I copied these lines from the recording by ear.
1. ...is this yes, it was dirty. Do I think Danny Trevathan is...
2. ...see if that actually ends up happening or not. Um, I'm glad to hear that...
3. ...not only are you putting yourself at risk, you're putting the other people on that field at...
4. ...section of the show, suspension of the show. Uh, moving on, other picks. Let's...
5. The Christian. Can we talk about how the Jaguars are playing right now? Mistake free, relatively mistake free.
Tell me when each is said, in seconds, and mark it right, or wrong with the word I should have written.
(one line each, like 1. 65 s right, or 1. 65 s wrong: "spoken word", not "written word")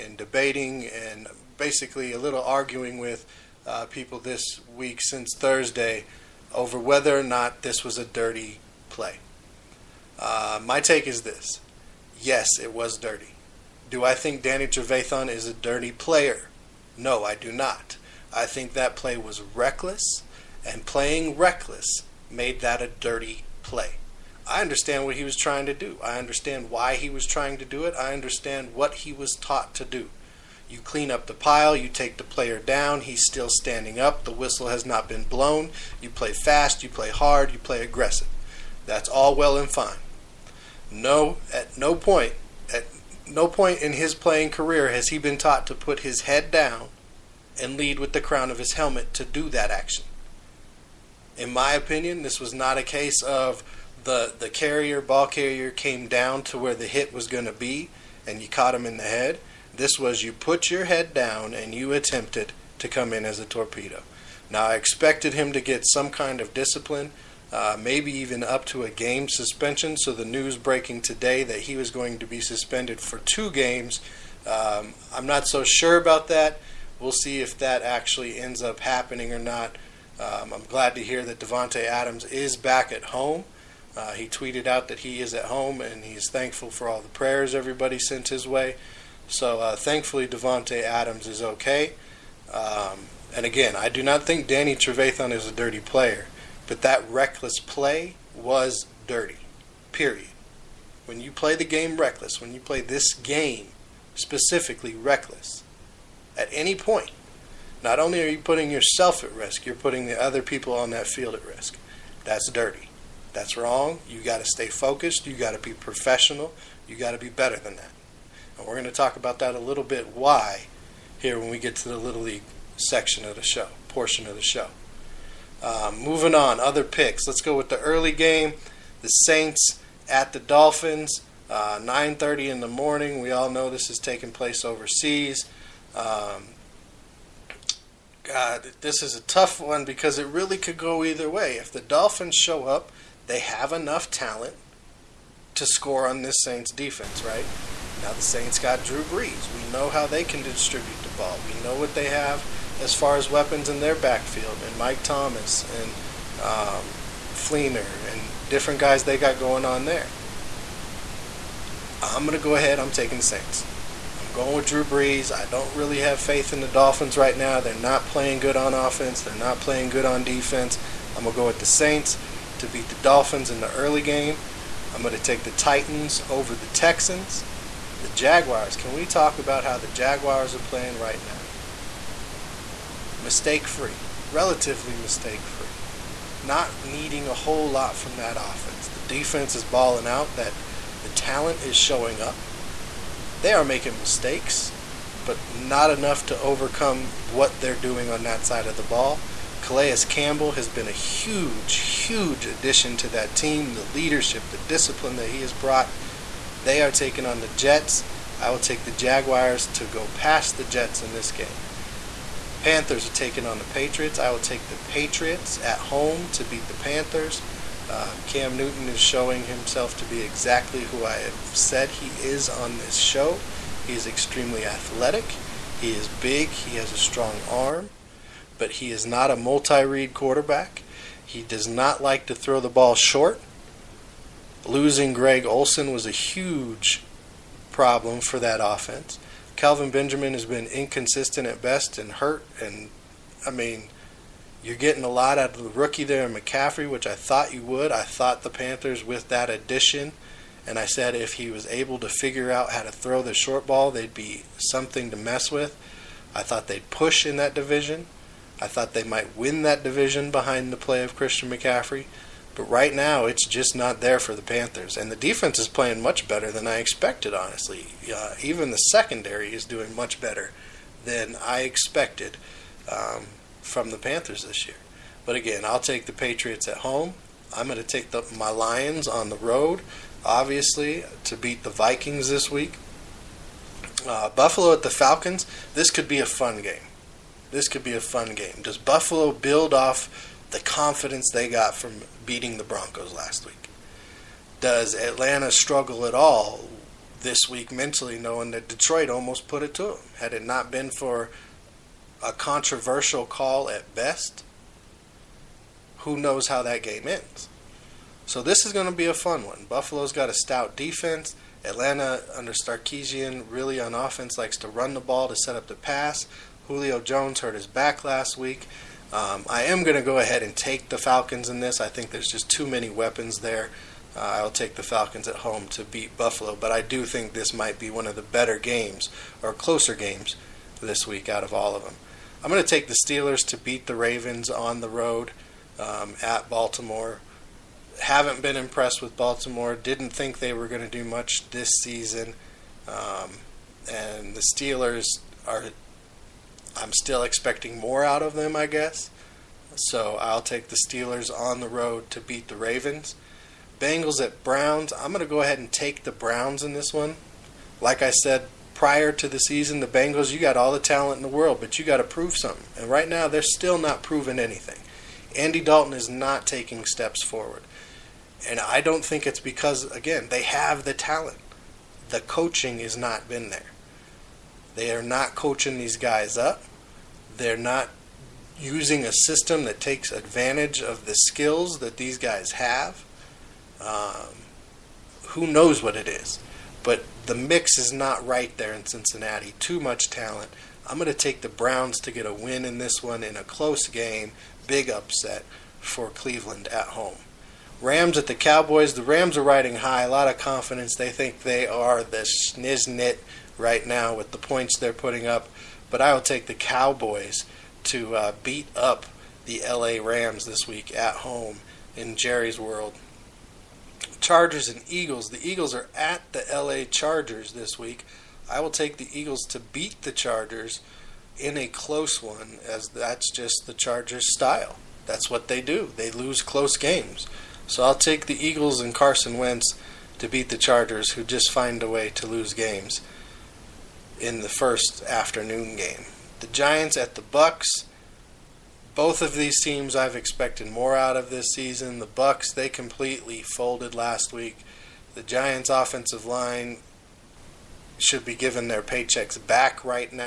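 1. 11 s right
2. 77 s right
3. 107 s right
4. 122 s wrong: "portion", not "suspension"
5. 178 s wrong: "Jaguars", not "Christian".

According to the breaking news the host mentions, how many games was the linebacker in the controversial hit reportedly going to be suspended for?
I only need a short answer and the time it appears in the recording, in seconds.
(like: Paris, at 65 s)
2, at 73 s.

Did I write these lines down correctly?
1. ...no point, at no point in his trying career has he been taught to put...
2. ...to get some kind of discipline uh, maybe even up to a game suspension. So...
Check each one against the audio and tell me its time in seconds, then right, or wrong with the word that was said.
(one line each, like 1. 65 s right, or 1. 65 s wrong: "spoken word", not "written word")
1. 41 s wrong: "playing", not "trying"
2. 65 s right.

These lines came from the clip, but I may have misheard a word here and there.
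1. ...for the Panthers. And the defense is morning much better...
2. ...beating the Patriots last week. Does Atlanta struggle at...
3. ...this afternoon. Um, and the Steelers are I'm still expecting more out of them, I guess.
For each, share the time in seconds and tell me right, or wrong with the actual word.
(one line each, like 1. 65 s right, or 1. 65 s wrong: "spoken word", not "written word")
1. 264 s wrong: "playing", not "morning"
2. 292 s wrong: "Broncos", not "Patriots"
3. 341 s wrong: "season", not "afternoon".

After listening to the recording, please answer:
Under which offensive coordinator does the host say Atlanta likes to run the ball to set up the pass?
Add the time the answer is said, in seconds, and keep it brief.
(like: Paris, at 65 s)
Sarkisian, at 312 s.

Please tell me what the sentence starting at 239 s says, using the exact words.
Kelvin Benjamin has been inconsistent at best and hurt.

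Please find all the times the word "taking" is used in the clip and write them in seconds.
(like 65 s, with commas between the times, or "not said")
133 s, 162 s, 206 s, 213 s, 366 s.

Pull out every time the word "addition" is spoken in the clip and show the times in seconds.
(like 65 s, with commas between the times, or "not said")
202 s, 249 s.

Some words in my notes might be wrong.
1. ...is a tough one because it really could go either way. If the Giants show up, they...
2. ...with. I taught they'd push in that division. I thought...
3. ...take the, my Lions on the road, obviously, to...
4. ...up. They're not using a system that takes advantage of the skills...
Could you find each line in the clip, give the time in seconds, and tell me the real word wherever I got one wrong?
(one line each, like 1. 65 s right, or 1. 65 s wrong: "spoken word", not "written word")
1. 139 s wrong: "Dolphins", not "Giants"
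2. 255 s wrong: "thought", not "taught"
3. 277 s right
4. 376 s right.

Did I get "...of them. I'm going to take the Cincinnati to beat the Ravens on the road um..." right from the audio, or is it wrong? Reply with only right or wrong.
wrong.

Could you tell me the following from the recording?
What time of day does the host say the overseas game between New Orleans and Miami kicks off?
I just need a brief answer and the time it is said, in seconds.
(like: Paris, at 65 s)
9:30 in the morning, at 131 s.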